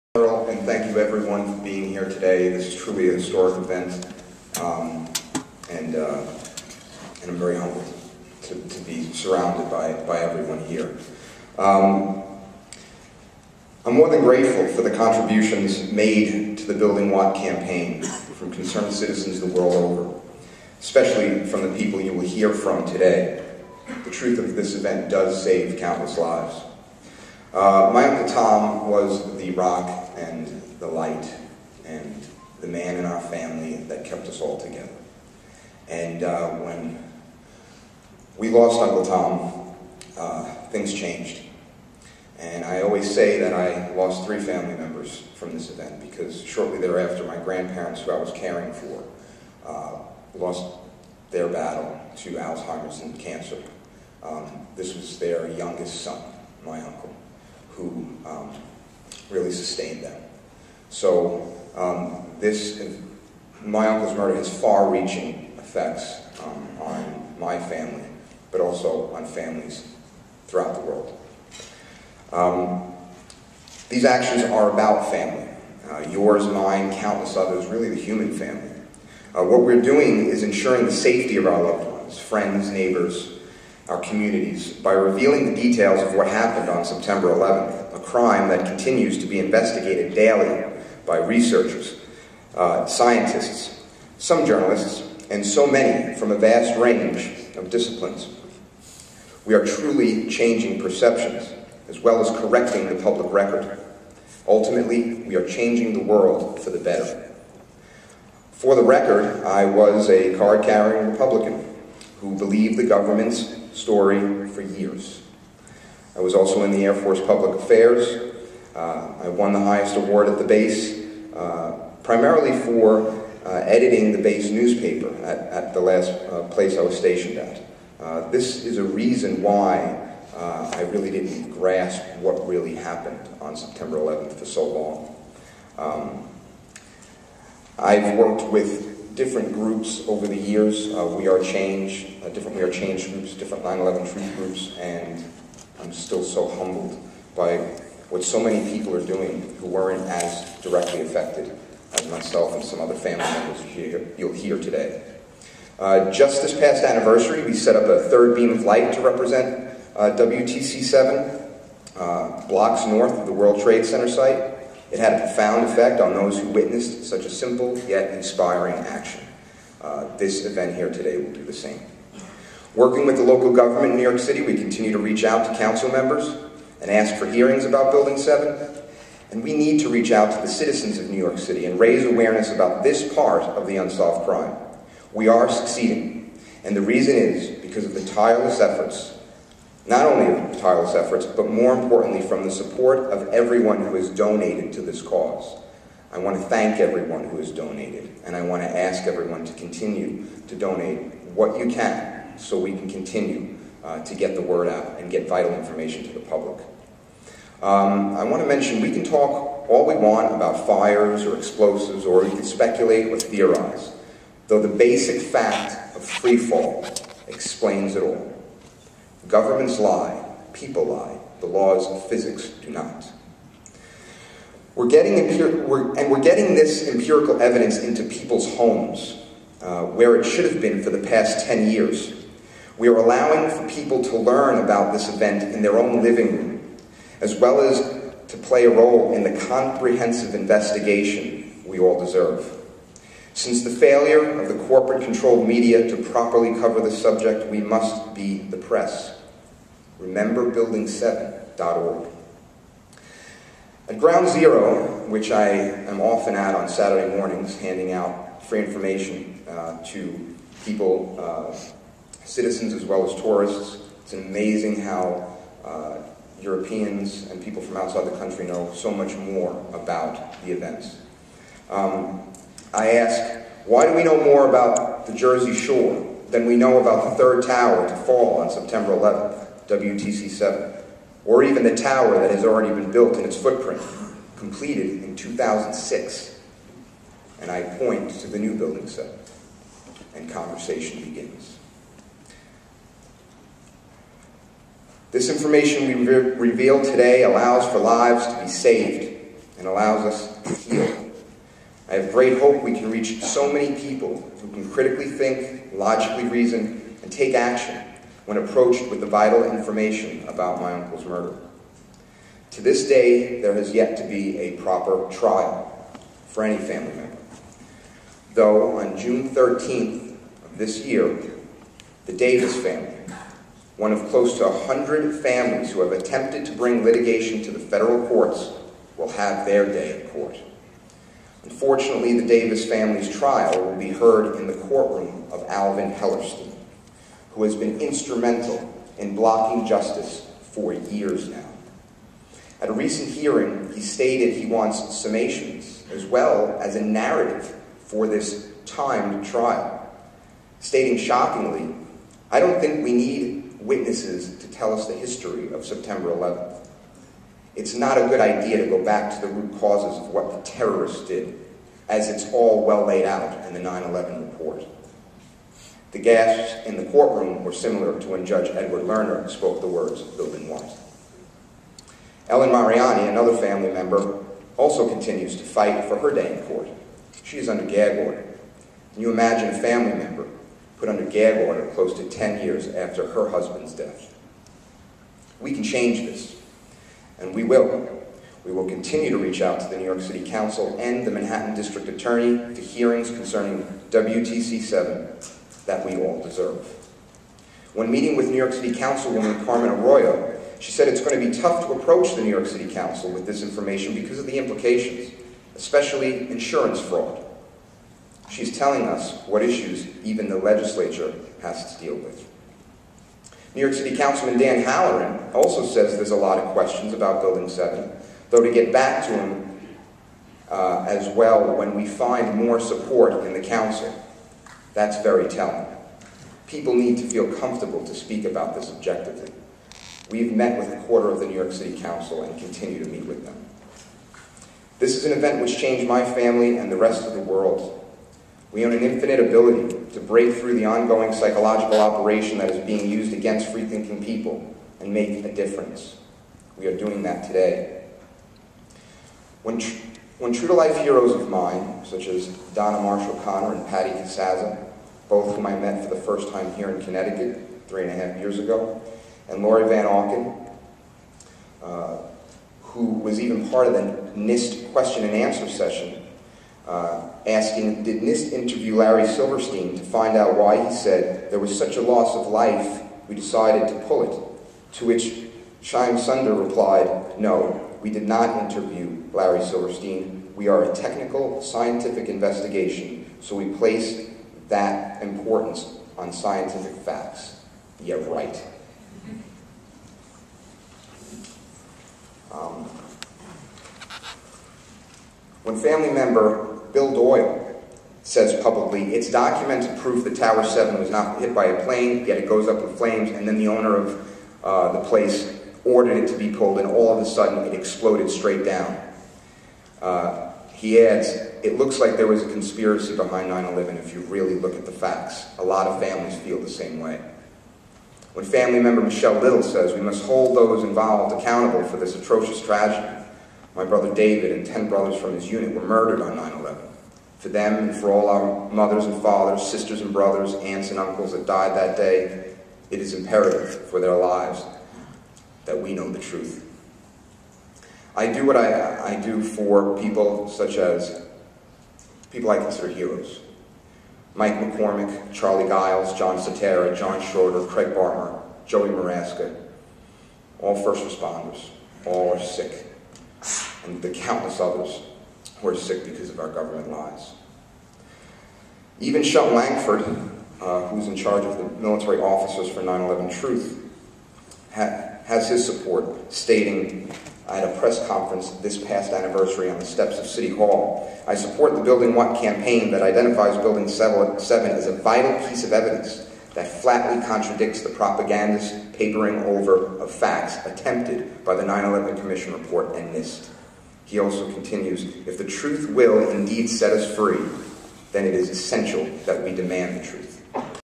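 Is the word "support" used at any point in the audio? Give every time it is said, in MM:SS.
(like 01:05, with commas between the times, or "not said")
03:12, 07:02, 09:25, 09:31.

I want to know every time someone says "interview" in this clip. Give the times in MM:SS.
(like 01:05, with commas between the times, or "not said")
07:48, 07:58.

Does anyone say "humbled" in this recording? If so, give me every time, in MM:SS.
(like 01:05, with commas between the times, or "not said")
00:07, 02:26.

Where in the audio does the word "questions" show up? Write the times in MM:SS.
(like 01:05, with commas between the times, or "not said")
06:56, 07:44.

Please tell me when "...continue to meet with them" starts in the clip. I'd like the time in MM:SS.
07:12.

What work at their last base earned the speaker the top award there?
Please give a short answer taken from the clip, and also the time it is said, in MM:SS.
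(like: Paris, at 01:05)
editing the base newspaper, at 02:03.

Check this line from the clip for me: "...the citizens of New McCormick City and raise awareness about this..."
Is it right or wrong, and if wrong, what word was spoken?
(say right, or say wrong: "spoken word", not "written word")
wrong: "York", not "McCormick".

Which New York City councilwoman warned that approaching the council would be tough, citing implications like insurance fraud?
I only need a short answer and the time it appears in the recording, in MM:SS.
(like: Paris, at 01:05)
Carmen Arroyo, at 06:39.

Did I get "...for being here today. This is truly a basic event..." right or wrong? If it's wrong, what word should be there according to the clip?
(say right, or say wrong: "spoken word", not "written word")
wrong: "historic", not "basic".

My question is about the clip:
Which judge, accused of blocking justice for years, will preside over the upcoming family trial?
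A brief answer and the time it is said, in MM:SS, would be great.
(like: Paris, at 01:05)
Alvin Hellerstein, at 05:35.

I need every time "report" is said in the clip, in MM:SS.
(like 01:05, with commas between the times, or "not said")
06:04, 09:42.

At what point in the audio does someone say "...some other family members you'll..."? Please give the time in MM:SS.
02:32.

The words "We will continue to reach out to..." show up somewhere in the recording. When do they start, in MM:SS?
06:28.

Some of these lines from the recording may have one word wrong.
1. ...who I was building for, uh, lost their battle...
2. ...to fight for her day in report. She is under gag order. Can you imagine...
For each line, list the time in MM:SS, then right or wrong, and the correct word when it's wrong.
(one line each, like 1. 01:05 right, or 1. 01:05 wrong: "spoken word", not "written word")
1. 00:48 wrong: "caring", not "building"
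2. 06:15 wrong: "court", not "report".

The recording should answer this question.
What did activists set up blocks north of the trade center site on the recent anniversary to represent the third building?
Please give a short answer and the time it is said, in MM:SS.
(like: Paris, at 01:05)
a third beam of light, at 02:38.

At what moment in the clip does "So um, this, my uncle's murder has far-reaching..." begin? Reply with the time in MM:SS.
01:00.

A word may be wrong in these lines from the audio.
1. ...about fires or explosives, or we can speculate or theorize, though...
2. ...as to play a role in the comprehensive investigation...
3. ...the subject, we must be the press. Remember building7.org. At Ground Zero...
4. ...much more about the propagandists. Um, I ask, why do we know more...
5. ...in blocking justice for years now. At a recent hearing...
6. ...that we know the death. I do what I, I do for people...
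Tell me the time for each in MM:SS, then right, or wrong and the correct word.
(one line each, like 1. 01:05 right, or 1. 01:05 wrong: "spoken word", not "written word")
1. 03:30 right
2. 03:57 right
3. 04:06 right
4. 04:28 wrong: "events", not "propagandists"
5. 05:38 right
6. 08:55 wrong: "truth", not "death".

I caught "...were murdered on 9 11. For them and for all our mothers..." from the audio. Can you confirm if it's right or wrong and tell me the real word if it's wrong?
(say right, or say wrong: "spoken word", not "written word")
right.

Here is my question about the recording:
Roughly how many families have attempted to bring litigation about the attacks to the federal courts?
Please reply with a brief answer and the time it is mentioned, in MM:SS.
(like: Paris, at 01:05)
100, at 05:24.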